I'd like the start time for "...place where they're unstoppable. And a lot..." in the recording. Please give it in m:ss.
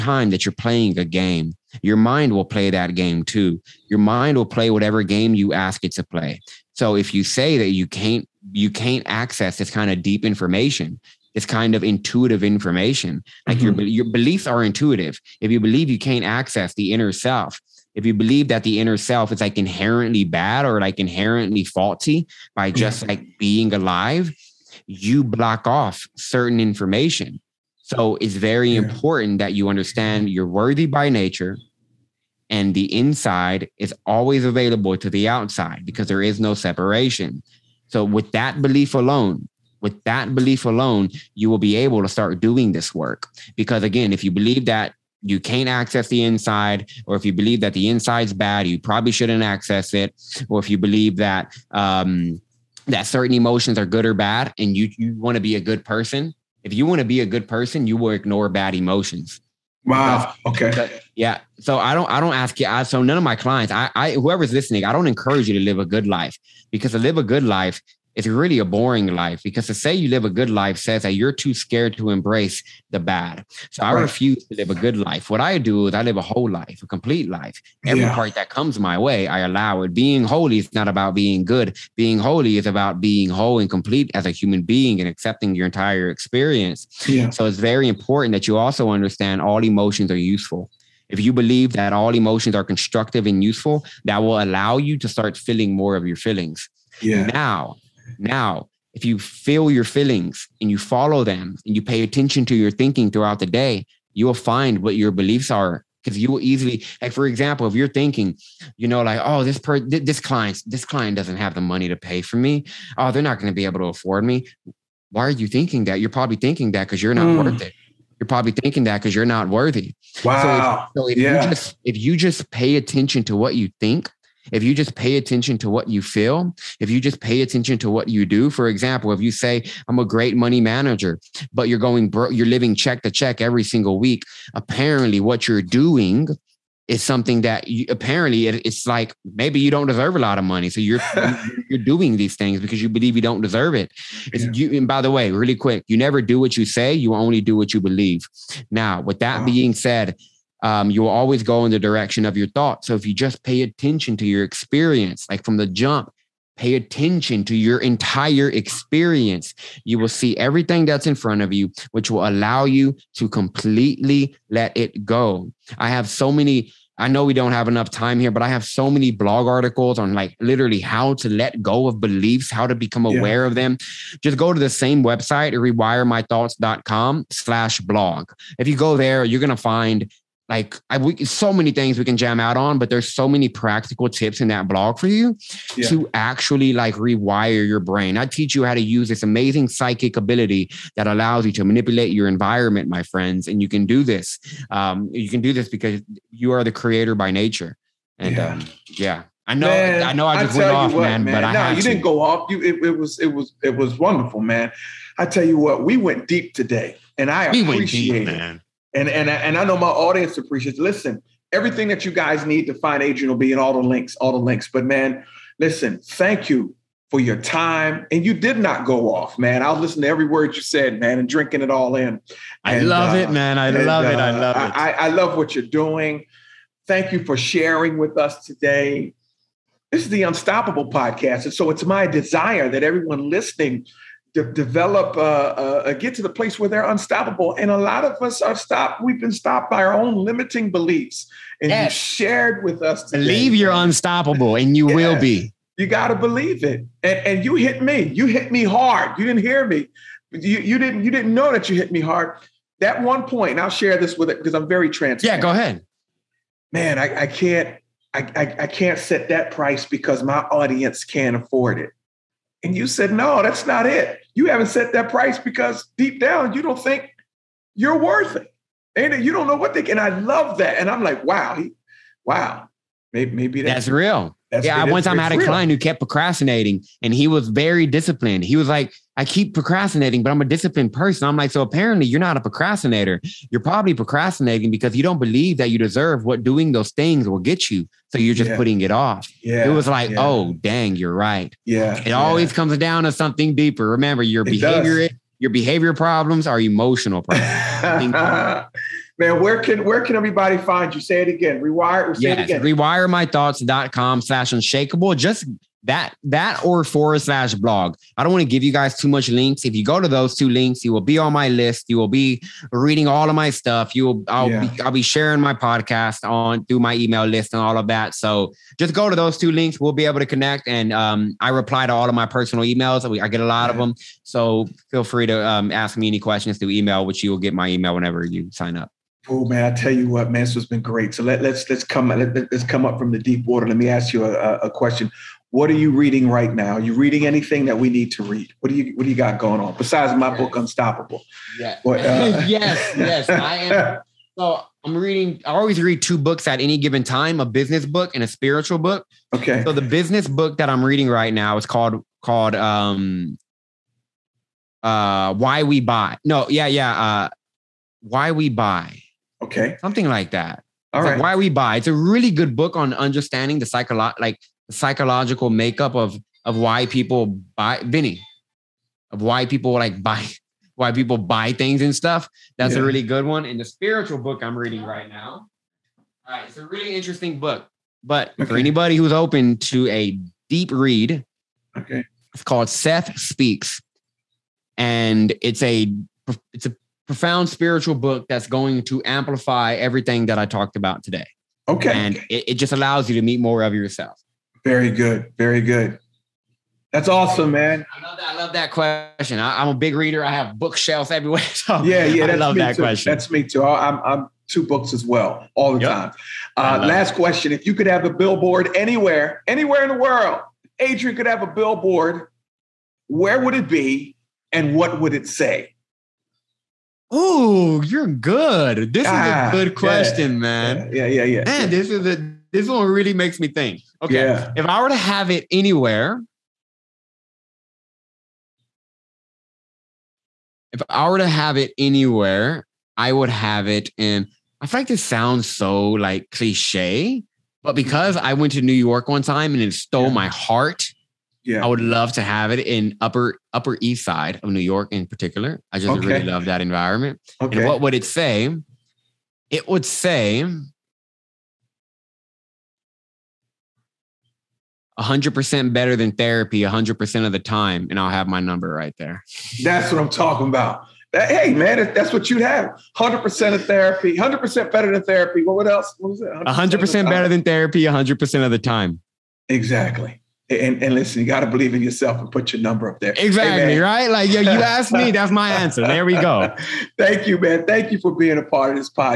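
3:56.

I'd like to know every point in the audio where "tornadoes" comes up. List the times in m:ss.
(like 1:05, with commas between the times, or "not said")
not said.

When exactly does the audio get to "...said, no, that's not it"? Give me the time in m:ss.
4:22.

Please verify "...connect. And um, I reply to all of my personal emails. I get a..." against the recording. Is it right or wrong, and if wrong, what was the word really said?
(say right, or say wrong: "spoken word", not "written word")
right.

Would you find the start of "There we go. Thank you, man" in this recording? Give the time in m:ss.
7:55.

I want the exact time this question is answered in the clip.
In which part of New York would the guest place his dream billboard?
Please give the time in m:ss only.
7:23.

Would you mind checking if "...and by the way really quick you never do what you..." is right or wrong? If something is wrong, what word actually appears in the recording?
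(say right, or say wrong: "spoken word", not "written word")
right.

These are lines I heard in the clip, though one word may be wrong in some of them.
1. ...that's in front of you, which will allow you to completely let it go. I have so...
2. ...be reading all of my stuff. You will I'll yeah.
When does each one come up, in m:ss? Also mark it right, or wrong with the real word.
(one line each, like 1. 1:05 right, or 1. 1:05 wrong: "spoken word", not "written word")
1. 2:40 right
2. 5:12 right.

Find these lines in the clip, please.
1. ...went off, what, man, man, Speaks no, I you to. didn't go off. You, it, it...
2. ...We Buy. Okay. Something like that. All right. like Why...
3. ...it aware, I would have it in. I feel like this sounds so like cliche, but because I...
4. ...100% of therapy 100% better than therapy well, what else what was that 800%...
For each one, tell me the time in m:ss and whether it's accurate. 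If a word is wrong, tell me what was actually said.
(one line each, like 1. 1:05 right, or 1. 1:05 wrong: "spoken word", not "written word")
1. 3:20 wrong: "But", not "Speaks"
2. 5:58 right
3. 7:11 wrong: "anywhere", not "aware"
4. 7:42 wrong: "100", not "800".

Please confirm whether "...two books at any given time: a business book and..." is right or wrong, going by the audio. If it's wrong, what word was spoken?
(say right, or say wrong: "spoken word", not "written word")
right.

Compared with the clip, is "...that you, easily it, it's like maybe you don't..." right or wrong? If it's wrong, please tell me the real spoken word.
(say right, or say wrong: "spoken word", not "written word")
wrong: "apparently", not "easily".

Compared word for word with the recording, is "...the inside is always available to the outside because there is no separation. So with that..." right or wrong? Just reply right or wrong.
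right.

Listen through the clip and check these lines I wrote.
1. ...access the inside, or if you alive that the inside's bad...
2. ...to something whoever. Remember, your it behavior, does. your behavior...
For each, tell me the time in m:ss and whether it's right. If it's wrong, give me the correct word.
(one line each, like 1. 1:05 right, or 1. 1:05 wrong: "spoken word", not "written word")
1. 0:45 wrong: "believe", not "alive"
2. 4:53 wrong: "deeper", not "whoever".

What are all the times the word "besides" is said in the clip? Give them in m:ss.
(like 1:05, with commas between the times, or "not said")
5:39.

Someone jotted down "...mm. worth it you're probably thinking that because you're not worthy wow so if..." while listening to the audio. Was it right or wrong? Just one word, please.
right.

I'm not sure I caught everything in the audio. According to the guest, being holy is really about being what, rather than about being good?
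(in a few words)
whole and complete.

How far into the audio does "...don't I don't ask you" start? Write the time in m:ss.
1:01.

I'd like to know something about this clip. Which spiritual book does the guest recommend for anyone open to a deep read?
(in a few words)
Seth Speaks.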